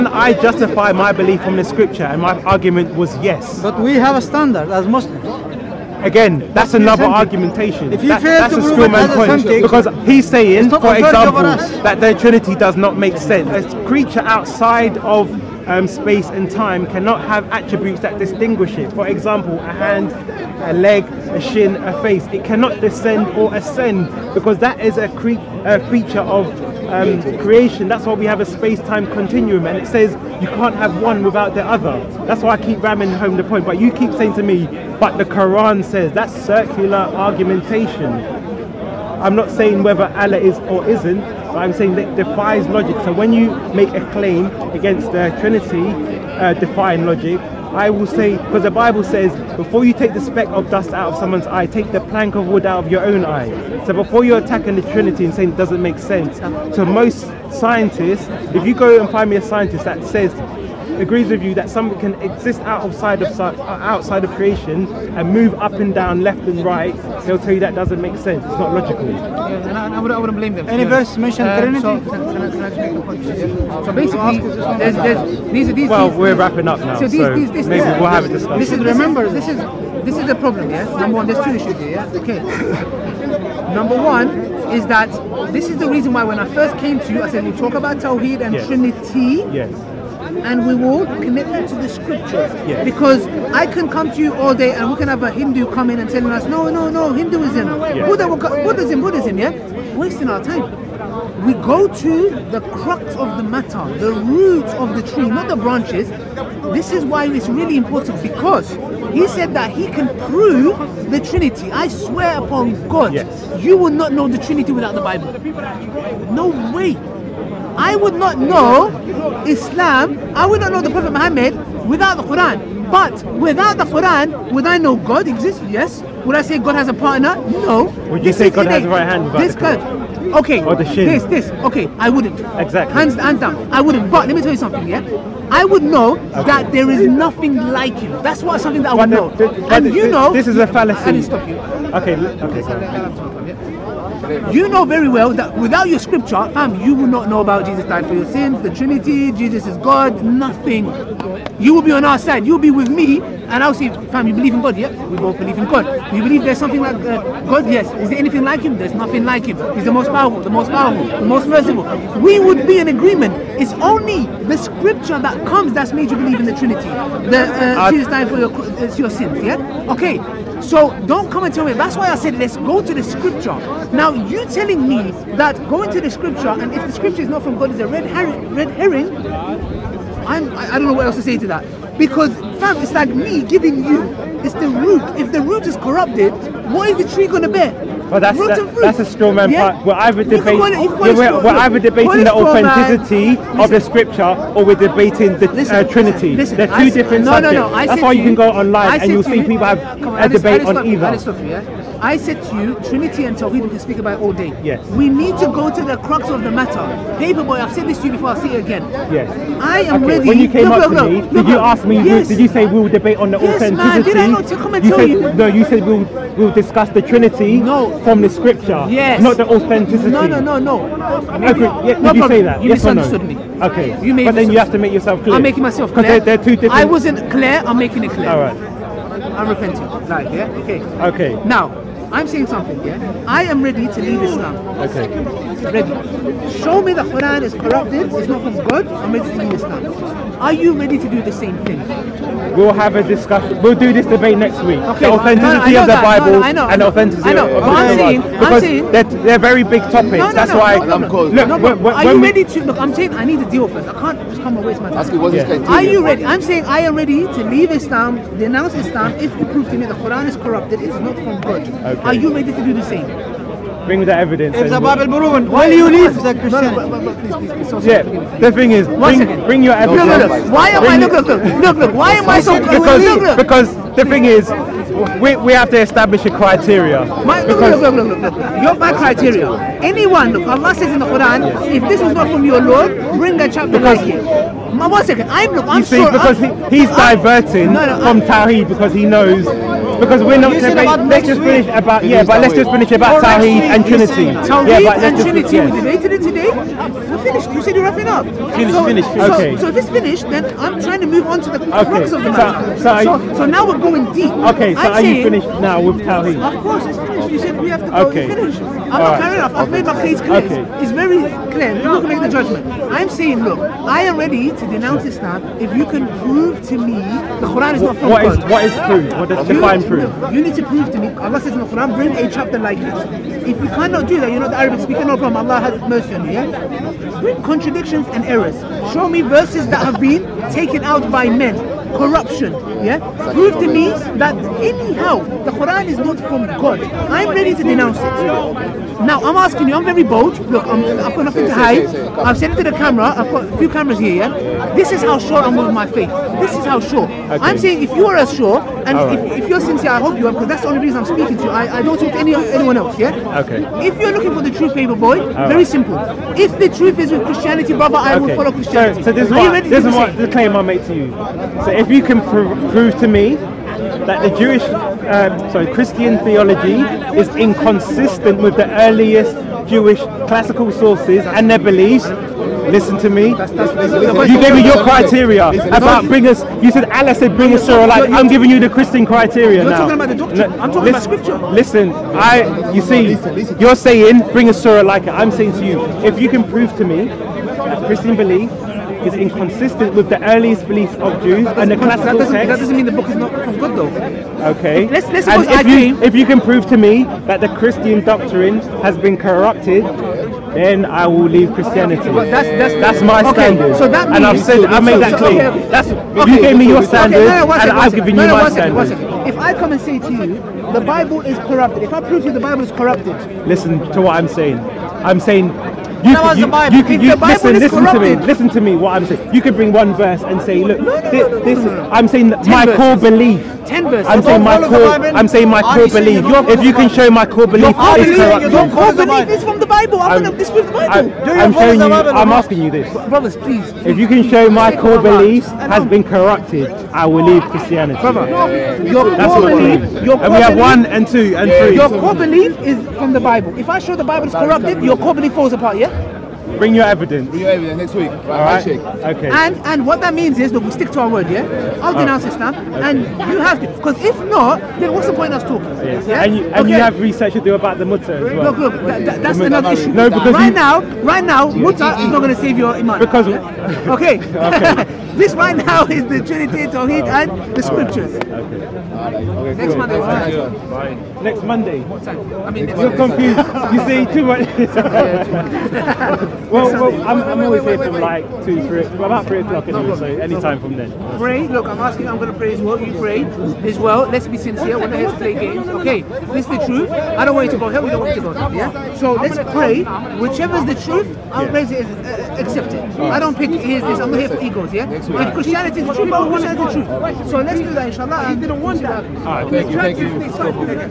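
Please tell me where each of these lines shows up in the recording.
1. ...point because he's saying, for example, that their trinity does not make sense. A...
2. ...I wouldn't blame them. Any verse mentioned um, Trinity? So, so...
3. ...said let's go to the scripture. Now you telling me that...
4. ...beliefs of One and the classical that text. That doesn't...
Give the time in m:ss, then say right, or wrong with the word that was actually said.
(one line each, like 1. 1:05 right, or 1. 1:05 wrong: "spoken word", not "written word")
1. 0:09 right
2. 1:10 right
3. 2:52 right
4. 6:30 wrong: "Jews", not "One".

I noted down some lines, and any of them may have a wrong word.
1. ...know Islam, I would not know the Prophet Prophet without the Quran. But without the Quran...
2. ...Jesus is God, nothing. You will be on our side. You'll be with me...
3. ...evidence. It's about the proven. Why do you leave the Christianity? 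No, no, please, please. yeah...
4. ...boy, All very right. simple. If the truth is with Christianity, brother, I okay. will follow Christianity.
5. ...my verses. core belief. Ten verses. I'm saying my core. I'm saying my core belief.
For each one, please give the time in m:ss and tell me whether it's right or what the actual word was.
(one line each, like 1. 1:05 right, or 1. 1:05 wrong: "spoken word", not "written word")
1. 1:58 wrong: "Muhammad", not "Prophet"
2. 2:29 right
3. 4:24 right
4. 5:54 right
5. 7:02 right.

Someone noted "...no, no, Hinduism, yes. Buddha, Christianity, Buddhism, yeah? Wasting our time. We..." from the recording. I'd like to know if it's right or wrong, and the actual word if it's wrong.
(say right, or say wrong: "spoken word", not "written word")
wrong: "Buddhism", not "Christianity".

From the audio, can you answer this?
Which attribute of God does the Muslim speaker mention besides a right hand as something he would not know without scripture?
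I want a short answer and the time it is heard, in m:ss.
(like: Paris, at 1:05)
The shin, at 2:10.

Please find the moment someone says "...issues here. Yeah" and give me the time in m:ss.
1:21.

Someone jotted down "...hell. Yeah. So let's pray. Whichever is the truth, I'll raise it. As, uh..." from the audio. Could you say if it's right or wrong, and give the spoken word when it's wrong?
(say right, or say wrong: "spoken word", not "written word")
right.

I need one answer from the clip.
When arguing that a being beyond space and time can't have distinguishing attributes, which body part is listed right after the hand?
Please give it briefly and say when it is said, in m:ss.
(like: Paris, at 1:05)
A leg, at 0:20.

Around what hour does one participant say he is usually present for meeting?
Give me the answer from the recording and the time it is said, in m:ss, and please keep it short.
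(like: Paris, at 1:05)
3 o'clock, at 7:59.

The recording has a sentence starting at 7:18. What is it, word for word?
Brother, your That's core belief, your core and we have one and two and three.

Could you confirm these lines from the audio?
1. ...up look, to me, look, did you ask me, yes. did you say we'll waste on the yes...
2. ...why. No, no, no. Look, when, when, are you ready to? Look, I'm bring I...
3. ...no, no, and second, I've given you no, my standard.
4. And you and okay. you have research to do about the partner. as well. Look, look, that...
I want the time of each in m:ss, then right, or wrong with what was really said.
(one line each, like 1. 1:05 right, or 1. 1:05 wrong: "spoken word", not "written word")
1. 3:30 wrong: "debate", not "waste"
2. 4:10 wrong: "saying", not "bring"
3. 6:47 right
4. 7:36 wrong: "mutter", not "partner".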